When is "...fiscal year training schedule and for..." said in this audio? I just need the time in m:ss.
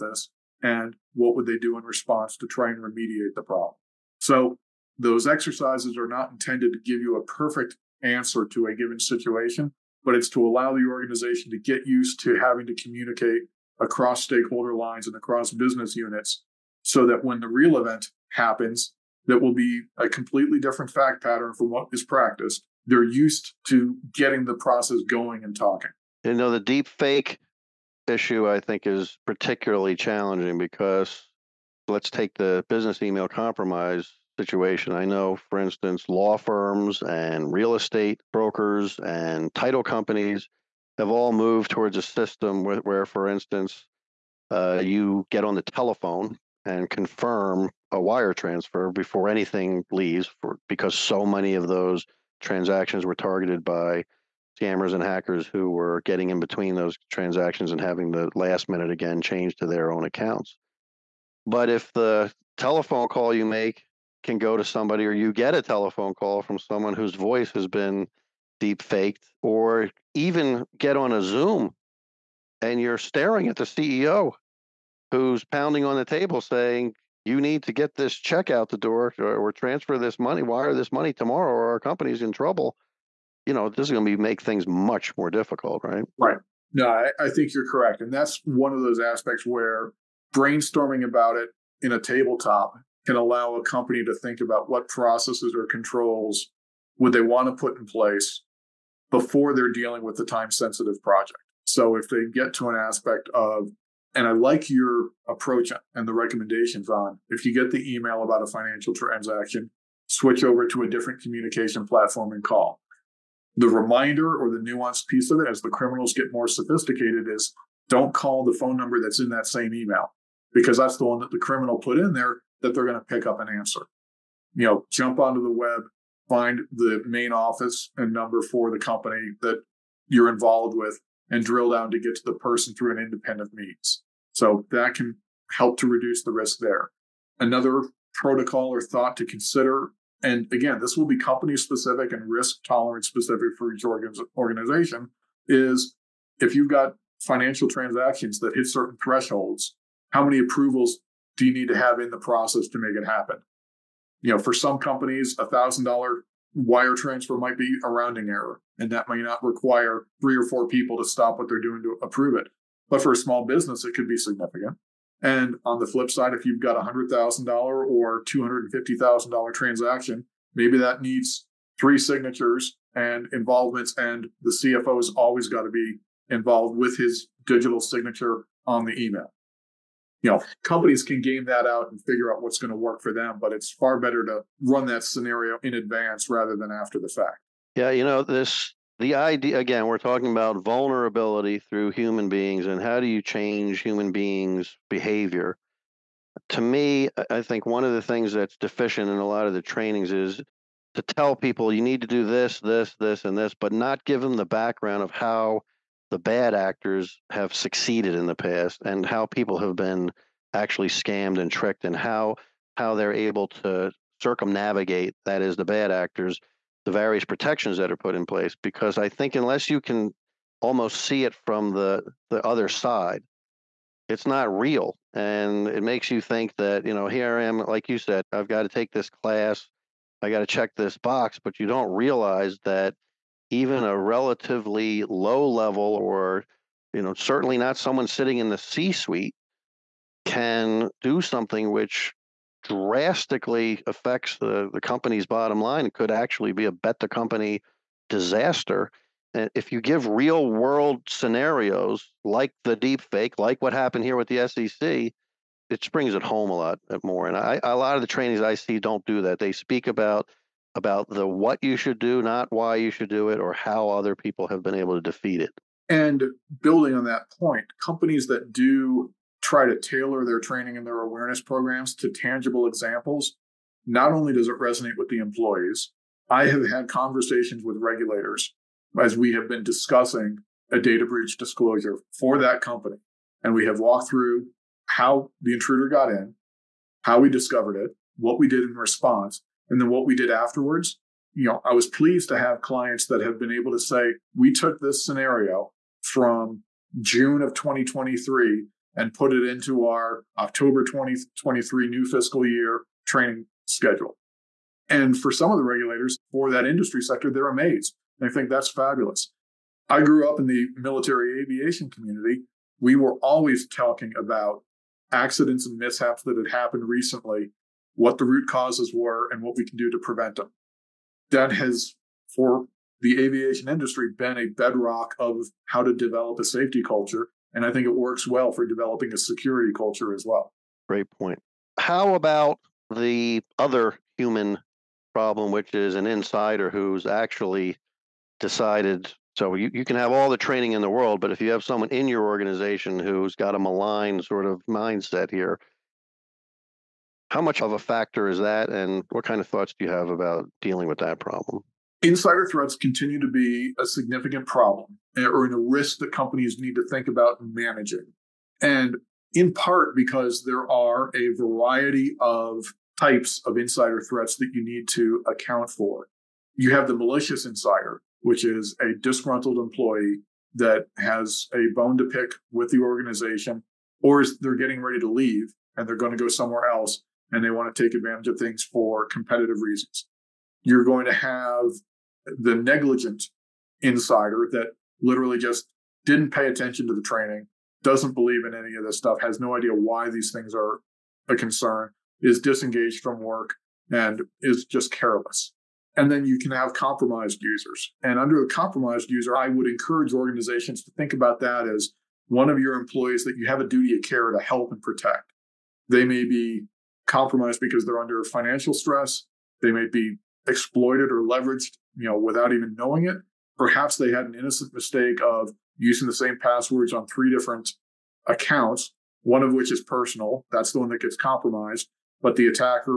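5:02.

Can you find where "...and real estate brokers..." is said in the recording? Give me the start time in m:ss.
0:37.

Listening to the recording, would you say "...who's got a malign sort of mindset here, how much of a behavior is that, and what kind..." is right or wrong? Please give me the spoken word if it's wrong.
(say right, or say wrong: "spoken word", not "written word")
wrong: "factor", not "behavior".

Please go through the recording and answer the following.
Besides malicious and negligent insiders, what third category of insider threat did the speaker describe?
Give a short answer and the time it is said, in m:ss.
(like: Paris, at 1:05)
Compromised users, at 6:36.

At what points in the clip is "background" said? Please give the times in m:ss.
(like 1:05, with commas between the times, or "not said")
3:24.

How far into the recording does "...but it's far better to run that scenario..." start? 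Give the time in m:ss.
3:03.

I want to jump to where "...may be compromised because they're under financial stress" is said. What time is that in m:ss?
6:46.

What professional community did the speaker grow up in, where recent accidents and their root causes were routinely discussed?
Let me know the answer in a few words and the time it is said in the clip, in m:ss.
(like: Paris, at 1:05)
Military aviation, at 5:10.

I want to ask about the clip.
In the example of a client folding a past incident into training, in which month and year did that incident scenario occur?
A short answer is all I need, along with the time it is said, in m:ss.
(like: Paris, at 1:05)
June 2023, at 4:57.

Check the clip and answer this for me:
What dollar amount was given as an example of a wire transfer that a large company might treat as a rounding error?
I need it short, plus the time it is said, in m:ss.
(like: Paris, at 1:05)
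$1,000, at 2:35.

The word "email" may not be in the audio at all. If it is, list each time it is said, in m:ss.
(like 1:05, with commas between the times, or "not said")
0:33, 1:47, 1:59, 2:59.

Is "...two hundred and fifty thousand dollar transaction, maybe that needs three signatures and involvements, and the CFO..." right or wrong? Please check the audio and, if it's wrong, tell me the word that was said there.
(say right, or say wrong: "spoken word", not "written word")
right.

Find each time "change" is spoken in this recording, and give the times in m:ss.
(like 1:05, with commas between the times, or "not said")
0:59, 3:13.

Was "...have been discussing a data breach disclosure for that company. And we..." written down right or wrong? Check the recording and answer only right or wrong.
right.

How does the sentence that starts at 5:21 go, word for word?
That has, for the aviation industry, been a bedrock of how to develop a safety culture.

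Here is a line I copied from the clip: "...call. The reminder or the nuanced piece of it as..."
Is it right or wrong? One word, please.
right.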